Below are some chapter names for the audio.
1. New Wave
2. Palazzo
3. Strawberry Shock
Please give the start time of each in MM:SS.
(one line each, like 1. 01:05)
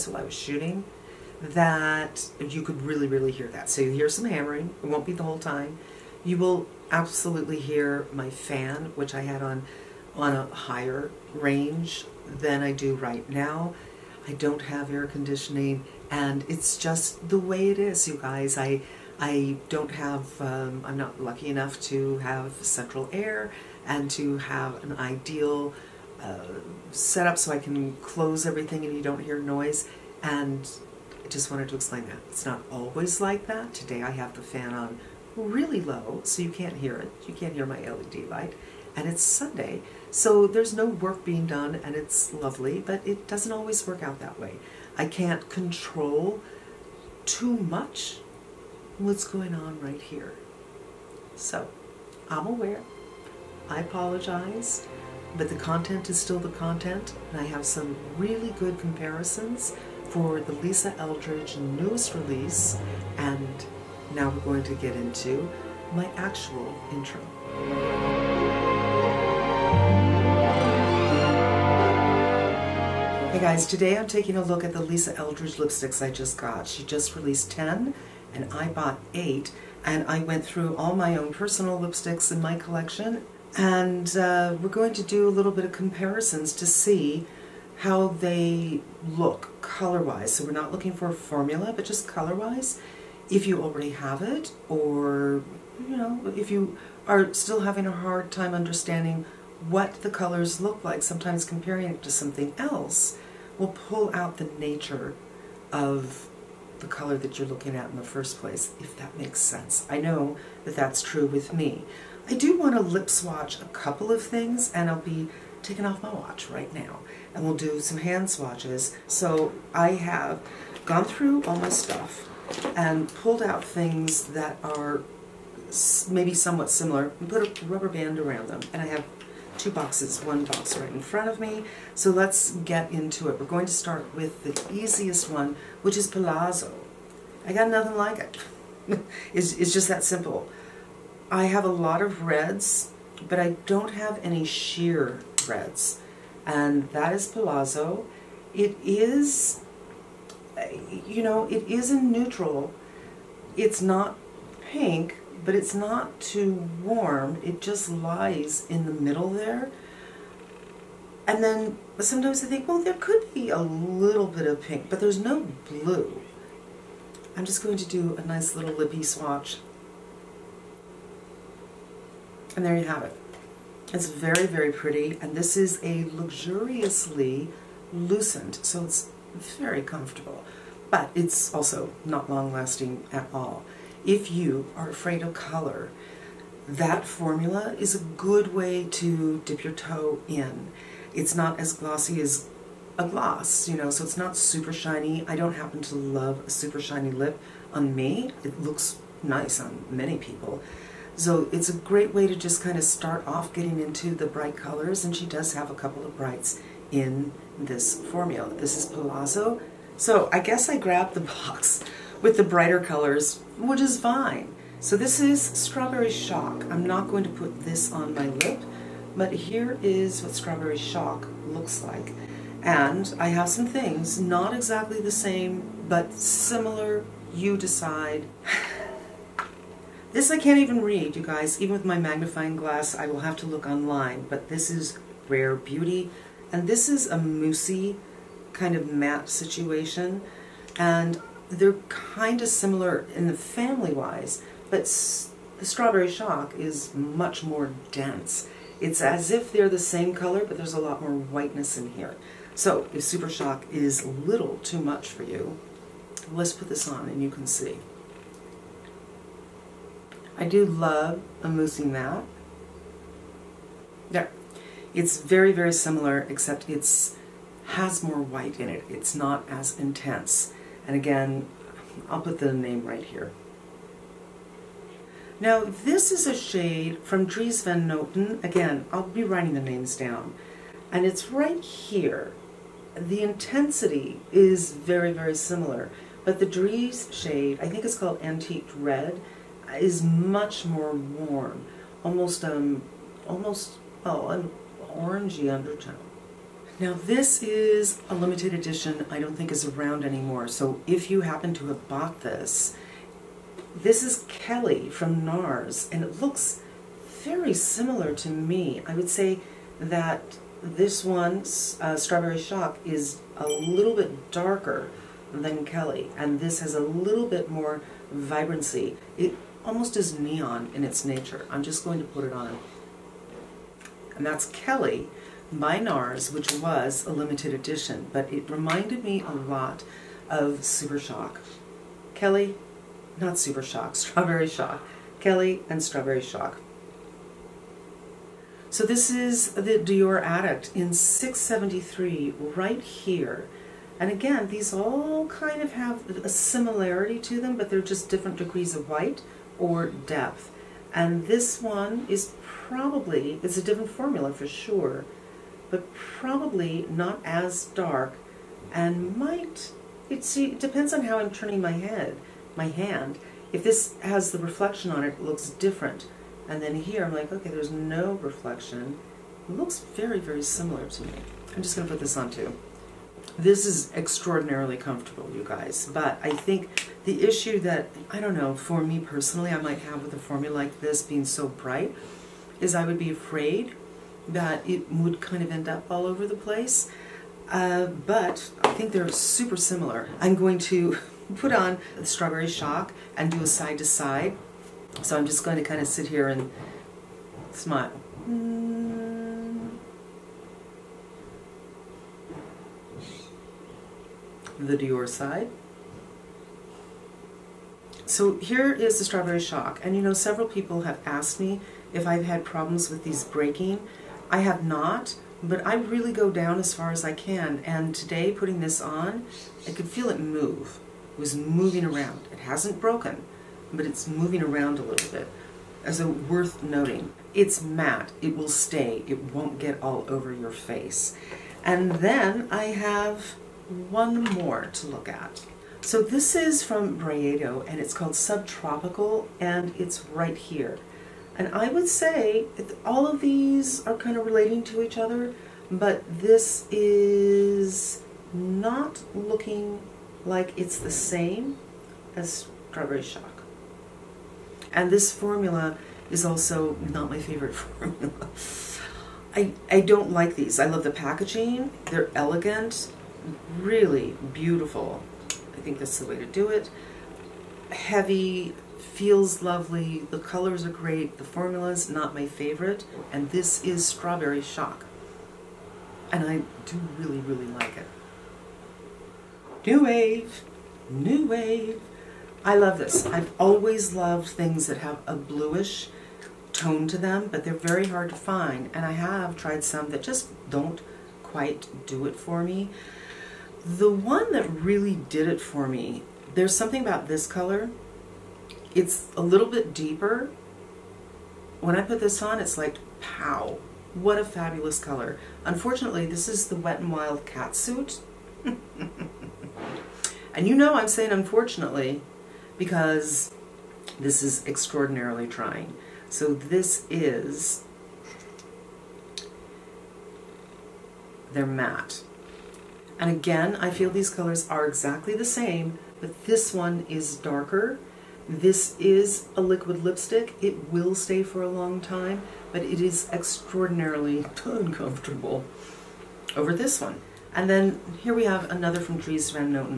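1. 07:57
2. 02:11
3. 03:33.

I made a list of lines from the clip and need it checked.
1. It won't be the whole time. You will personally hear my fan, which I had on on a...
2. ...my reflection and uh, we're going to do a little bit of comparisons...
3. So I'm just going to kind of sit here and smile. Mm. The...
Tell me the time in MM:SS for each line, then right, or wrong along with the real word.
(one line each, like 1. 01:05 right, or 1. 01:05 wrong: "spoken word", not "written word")
1. 00:04 wrong: "absolutely", not "personally"
2. 01:22 wrong: "collection", not "reflection"
3. 06:35 right.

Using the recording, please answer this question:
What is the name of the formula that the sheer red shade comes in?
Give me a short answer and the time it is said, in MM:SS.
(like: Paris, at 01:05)
luxuriously lucent, at 02:56.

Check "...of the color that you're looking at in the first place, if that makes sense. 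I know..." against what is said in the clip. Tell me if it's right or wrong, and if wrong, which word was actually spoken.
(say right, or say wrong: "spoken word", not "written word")
right.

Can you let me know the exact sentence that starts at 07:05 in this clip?
As a worth noting, it's matte.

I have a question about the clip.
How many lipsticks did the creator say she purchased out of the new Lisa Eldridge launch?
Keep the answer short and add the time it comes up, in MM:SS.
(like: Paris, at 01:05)
8, at 01:18.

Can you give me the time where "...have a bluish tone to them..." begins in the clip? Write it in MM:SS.
08:04.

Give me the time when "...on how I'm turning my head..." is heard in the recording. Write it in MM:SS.
06:00.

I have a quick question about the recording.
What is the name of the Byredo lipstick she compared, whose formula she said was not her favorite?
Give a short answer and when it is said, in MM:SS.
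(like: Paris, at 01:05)
Subtropical, at 07:18.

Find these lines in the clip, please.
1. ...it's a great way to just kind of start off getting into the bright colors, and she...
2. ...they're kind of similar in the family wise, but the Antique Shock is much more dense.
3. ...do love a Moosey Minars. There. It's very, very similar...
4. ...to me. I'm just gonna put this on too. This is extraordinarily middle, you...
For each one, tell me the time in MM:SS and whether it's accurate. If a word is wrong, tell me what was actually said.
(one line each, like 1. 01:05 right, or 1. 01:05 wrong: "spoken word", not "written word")
1. 03:21 right
2. 04:01 wrong: "Strawberry", not "Antique"
3. 04:20 wrong: "Matte", not "Minars"
4. 06:10 wrong: "comfortable", not "middle".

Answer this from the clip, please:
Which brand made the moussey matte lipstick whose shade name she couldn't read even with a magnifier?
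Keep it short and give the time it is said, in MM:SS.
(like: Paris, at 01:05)
Rare Beauty, at 03:55.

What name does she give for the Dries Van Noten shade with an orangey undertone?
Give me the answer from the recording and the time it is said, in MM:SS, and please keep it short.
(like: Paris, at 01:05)
Antique Red, at 04:48.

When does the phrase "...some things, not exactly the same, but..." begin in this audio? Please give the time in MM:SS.
03:43.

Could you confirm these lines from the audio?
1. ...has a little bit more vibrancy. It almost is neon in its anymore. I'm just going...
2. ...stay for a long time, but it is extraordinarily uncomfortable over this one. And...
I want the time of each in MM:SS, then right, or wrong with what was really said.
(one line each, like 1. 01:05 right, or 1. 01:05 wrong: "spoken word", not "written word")
1. 05:16 wrong: "nature", not "anymore"
2. 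08:50 right.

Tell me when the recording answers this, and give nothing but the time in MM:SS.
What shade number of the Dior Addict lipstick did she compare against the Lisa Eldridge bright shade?
05:40.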